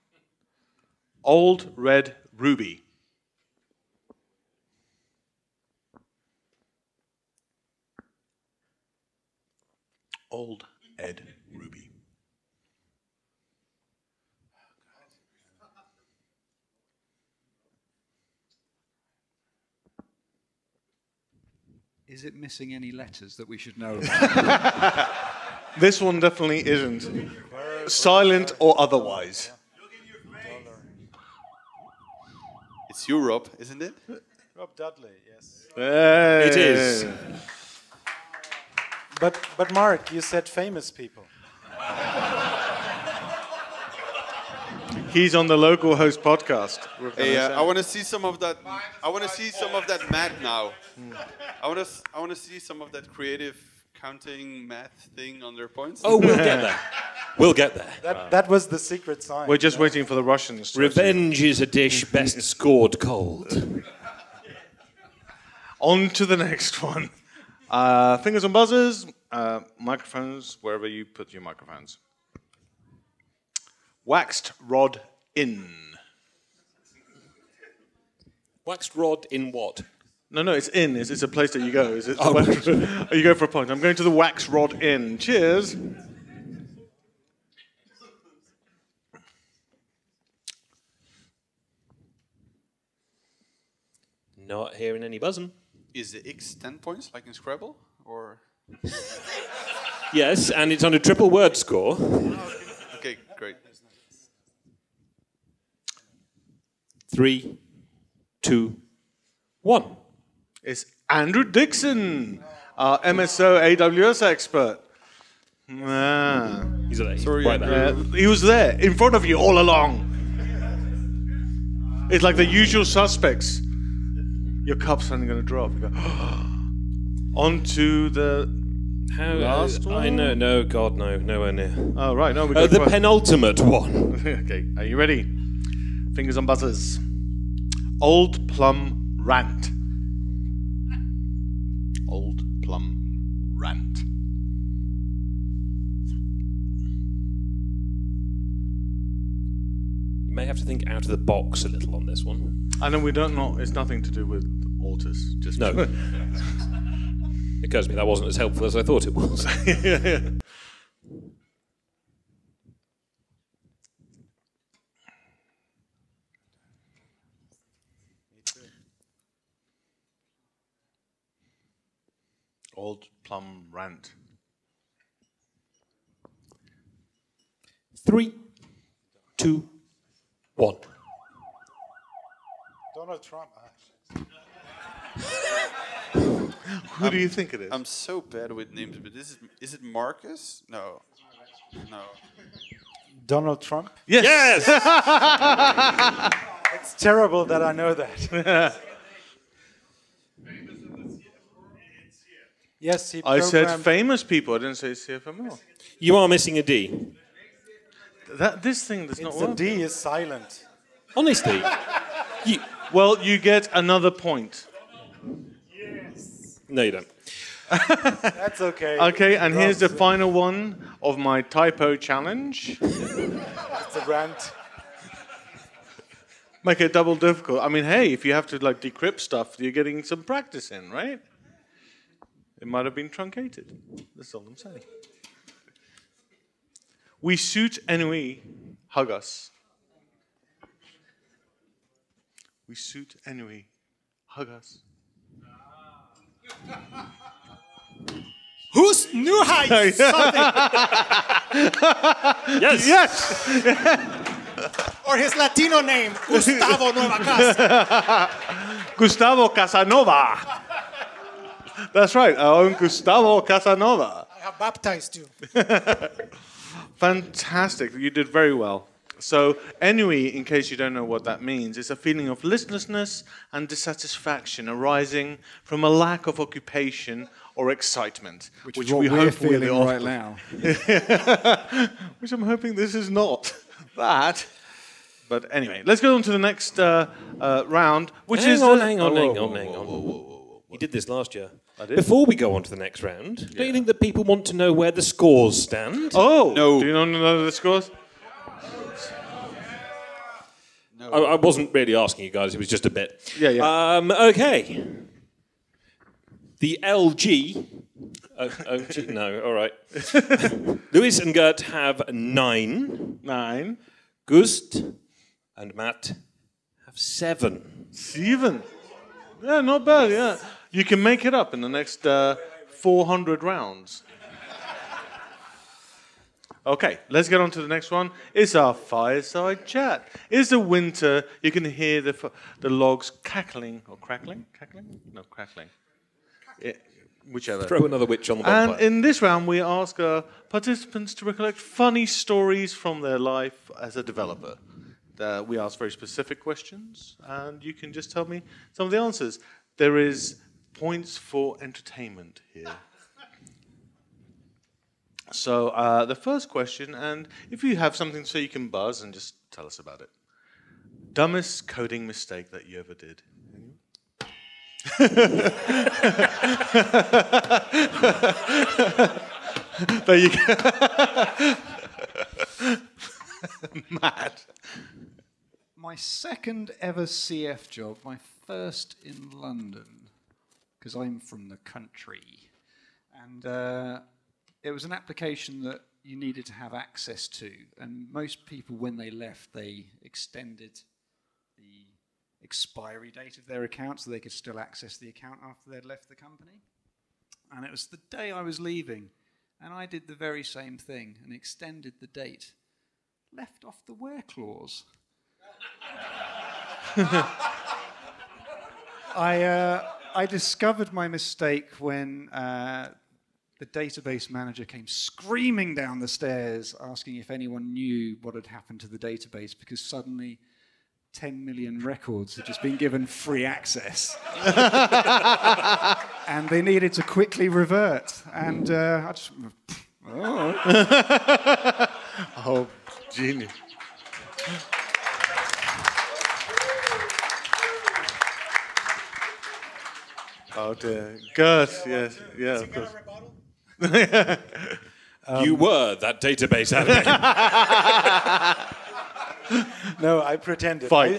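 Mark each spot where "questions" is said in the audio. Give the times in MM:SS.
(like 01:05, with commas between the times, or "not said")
05:46, 05:56.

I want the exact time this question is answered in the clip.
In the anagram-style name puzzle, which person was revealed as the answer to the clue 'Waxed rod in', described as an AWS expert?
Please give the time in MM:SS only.
01:51.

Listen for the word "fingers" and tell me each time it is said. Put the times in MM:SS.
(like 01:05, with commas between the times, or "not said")
01:08, 02:16.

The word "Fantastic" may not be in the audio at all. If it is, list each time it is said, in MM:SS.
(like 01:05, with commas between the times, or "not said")
04:26.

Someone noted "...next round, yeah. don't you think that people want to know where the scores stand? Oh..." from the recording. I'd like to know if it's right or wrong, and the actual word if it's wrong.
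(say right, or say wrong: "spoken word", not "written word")
right.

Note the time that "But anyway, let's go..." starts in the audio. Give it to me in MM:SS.
04:45.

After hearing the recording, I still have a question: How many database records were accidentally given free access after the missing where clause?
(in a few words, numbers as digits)
10 million.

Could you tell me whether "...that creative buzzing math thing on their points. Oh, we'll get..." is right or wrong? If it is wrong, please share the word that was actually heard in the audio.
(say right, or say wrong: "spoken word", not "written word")
wrong: "counting", not "buzzing".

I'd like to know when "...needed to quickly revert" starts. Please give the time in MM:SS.
07:06.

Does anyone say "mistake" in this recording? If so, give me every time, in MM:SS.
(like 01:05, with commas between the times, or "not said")
06:02, 06:51.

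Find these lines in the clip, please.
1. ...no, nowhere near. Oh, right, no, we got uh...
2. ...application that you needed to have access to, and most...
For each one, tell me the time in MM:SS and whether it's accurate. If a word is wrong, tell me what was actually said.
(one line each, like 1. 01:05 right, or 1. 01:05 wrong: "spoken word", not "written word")
1. 02:10 right
2. 06:24 right.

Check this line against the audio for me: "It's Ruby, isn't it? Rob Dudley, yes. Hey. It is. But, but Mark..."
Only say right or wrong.
wrong.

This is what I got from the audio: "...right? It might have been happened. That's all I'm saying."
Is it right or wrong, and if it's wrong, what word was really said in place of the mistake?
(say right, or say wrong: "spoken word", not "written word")
wrong: "truncated", not "happened".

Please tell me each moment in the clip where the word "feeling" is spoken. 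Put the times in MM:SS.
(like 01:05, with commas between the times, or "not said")
04:31, 04:39.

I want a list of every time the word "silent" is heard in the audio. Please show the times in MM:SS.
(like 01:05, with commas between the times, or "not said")
00:27, 03:29.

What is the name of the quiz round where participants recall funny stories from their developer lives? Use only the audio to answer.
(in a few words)
fireside chat.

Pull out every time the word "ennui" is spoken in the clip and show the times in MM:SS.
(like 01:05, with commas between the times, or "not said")
03:57, 04:29.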